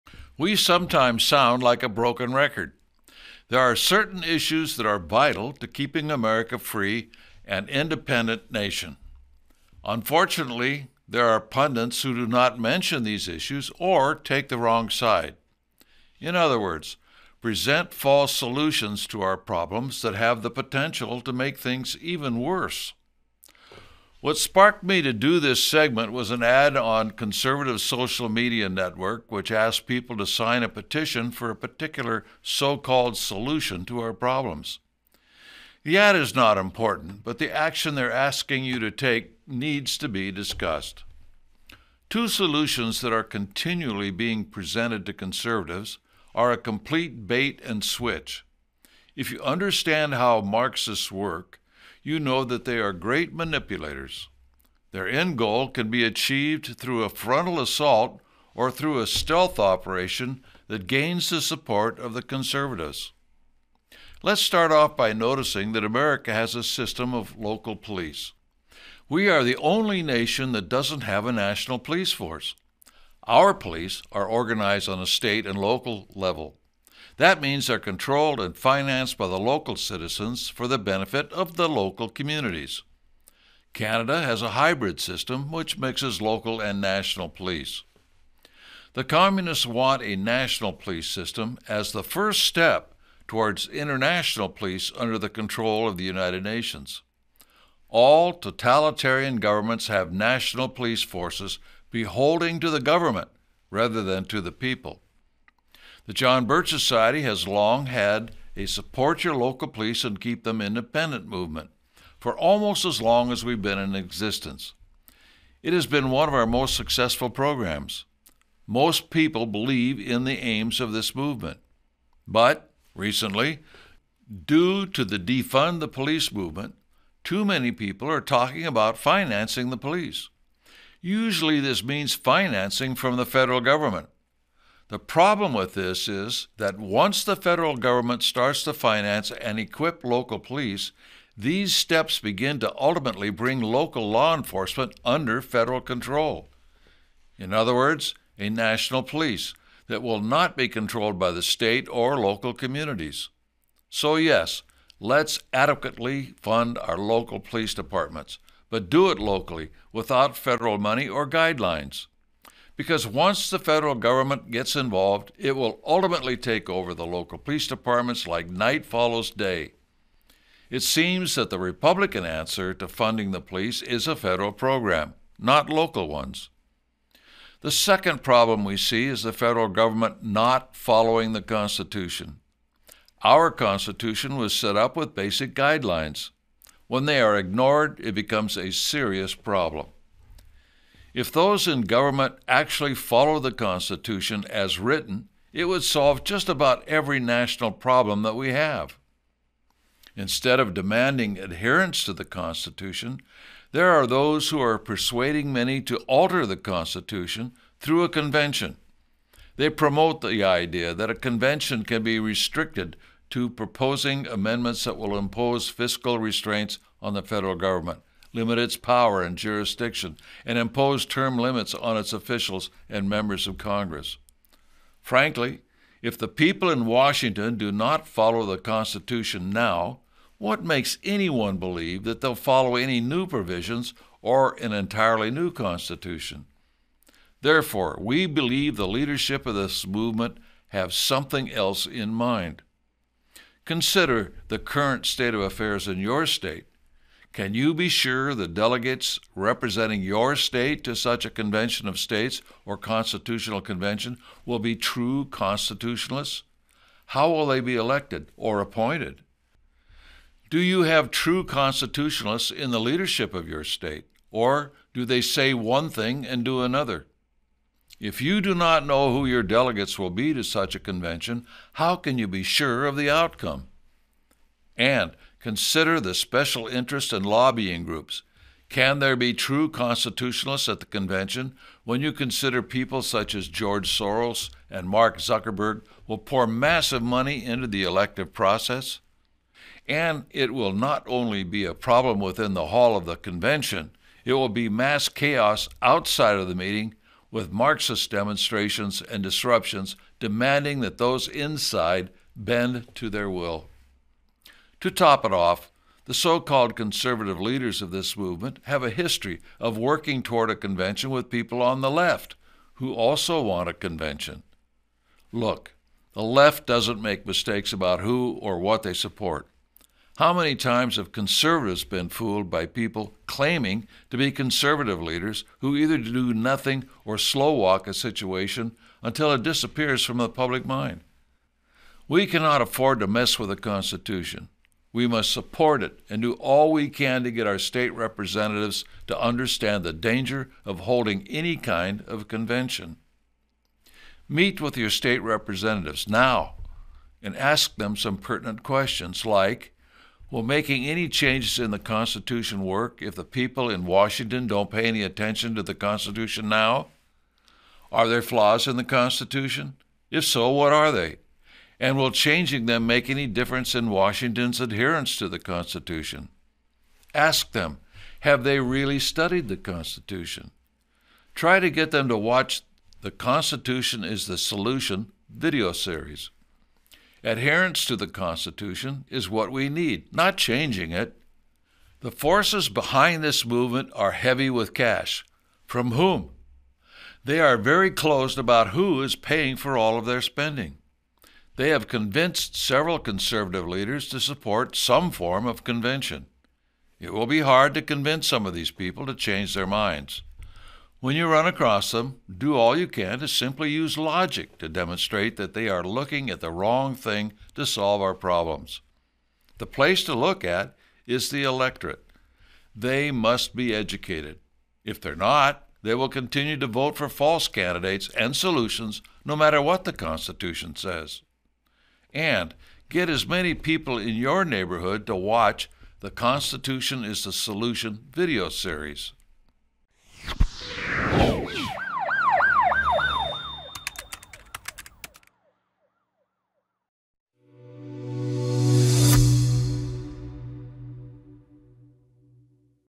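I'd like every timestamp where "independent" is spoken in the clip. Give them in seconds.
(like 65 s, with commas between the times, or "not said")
7 s, 110 s.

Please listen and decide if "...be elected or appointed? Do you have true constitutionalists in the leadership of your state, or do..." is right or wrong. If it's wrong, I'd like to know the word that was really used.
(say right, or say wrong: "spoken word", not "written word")
right.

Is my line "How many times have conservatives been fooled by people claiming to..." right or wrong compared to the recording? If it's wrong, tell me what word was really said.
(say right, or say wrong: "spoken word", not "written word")
right.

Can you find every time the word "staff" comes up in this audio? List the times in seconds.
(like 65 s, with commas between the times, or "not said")
not said.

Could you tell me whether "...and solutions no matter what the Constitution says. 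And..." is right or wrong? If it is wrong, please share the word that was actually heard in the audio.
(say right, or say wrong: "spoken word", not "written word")
right.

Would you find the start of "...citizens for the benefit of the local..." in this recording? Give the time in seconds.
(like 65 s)
79 s.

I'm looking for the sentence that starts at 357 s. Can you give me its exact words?
Are there flaws in the Constitution?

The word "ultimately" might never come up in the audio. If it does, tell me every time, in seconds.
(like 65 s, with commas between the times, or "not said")
142 s, 165 s.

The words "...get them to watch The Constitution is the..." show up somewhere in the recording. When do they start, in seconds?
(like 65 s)
371 s.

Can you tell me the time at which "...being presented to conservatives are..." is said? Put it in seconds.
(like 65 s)
44 s.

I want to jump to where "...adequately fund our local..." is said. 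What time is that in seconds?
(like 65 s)
155 s.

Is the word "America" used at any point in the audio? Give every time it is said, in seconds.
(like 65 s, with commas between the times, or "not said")
6 s, 65 s.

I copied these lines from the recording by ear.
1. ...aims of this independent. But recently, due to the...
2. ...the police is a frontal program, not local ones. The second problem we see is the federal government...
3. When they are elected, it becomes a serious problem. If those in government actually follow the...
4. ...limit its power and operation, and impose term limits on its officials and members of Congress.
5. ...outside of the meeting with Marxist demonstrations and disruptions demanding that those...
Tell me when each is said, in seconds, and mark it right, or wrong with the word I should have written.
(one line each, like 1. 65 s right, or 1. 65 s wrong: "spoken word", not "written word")
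1. 120 s wrong: "movement", not "independent"
2. 173 s wrong: "federal", not "frontal"
3. 186 s wrong: "ignored", not "elected"
4. 218 s wrong: "jurisdiction", not "operation"
5. 295 s right.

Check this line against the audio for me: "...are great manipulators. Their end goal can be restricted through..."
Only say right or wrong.
wrong.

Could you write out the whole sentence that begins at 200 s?
Instead of demanding adherence to the Constitution, there are those who are persuading many to alter the Constitution through a convention.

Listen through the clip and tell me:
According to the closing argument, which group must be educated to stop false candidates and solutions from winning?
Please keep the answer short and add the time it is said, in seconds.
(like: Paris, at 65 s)
the electorate, at 411 s.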